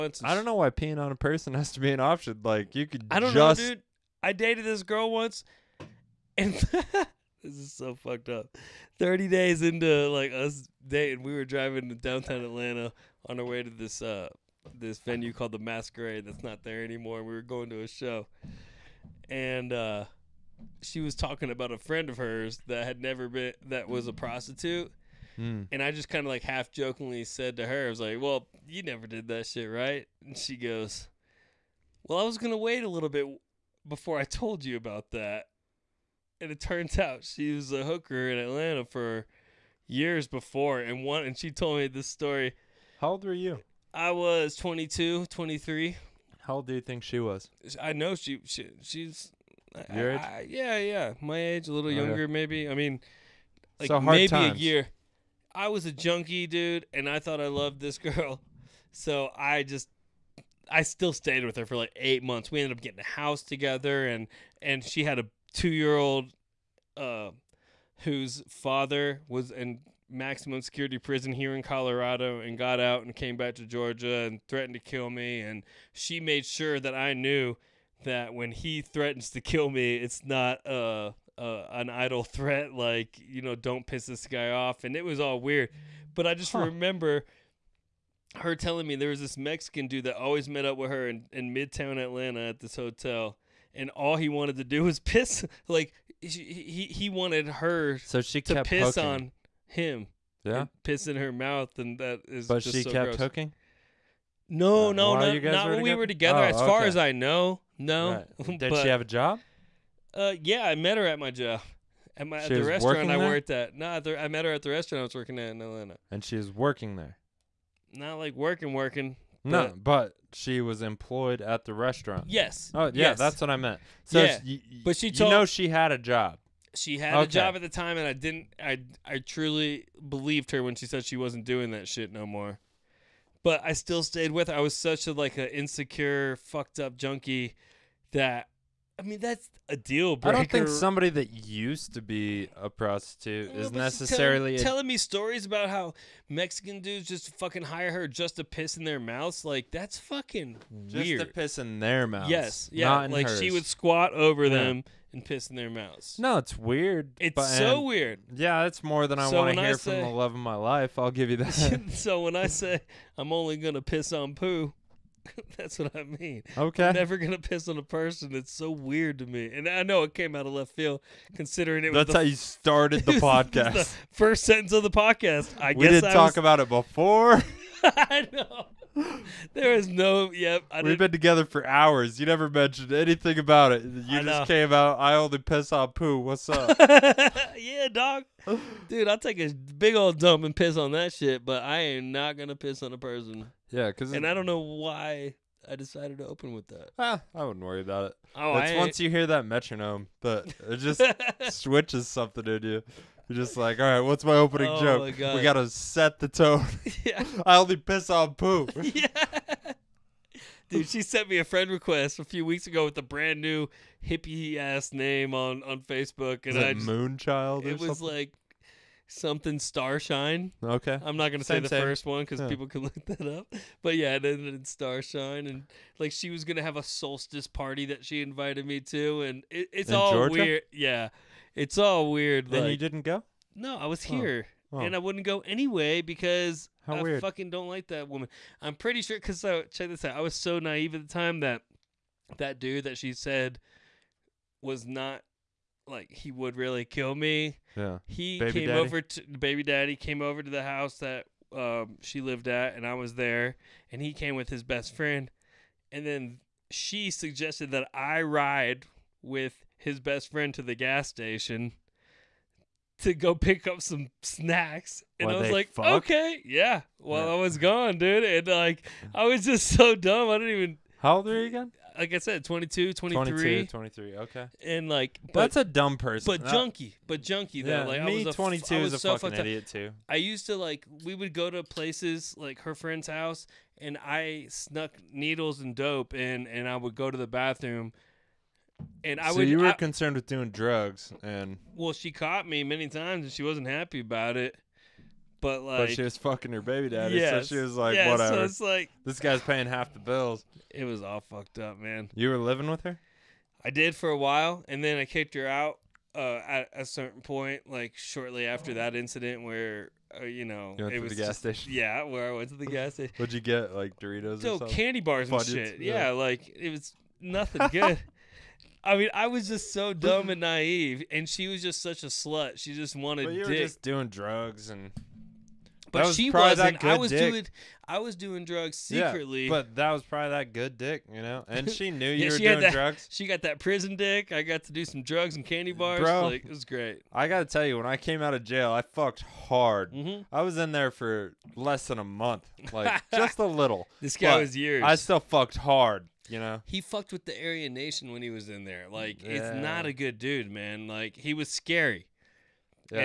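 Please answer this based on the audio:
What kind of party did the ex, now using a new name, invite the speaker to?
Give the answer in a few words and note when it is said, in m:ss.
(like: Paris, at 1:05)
A solstice party, at 3:46.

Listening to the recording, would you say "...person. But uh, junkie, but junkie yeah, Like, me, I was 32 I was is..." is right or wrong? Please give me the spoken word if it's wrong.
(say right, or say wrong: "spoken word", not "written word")
wrong: "22", not "32".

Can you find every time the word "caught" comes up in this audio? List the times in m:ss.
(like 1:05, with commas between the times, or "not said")
4:52.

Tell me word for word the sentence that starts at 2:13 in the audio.
But I still stayed with her.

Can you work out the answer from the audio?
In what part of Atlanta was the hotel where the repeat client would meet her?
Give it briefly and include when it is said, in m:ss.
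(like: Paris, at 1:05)
Midtown, at 1:31.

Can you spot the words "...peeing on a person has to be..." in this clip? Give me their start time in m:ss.
0:00.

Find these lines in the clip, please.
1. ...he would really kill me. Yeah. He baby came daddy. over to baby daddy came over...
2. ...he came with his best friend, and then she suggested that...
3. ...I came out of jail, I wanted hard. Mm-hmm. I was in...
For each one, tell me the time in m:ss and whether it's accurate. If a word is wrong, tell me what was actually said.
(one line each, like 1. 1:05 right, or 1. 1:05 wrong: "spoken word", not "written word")
1. 4:06 right
2. 4:14 right
3. 5:37 wrong: "fucked", not "wanted".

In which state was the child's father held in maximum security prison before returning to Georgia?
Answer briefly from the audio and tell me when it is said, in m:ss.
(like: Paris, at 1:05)
Colorado, at 1:11.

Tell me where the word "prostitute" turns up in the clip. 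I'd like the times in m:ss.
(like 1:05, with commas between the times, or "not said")
0:24, 2:22.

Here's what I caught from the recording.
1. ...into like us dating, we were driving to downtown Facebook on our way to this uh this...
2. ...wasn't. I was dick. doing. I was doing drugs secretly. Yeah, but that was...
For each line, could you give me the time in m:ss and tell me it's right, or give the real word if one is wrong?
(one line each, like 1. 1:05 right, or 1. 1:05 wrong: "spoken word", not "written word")
1. 0:09 wrong: "Atlanta", not "Facebook"
2. 5:26 right.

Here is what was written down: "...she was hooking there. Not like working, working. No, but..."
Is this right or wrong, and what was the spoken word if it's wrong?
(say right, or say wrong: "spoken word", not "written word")
wrong: "working", not "hooking".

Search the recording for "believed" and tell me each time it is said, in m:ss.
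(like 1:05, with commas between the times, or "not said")
2:10.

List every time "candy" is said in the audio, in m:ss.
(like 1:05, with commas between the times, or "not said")
5:14, 5:35.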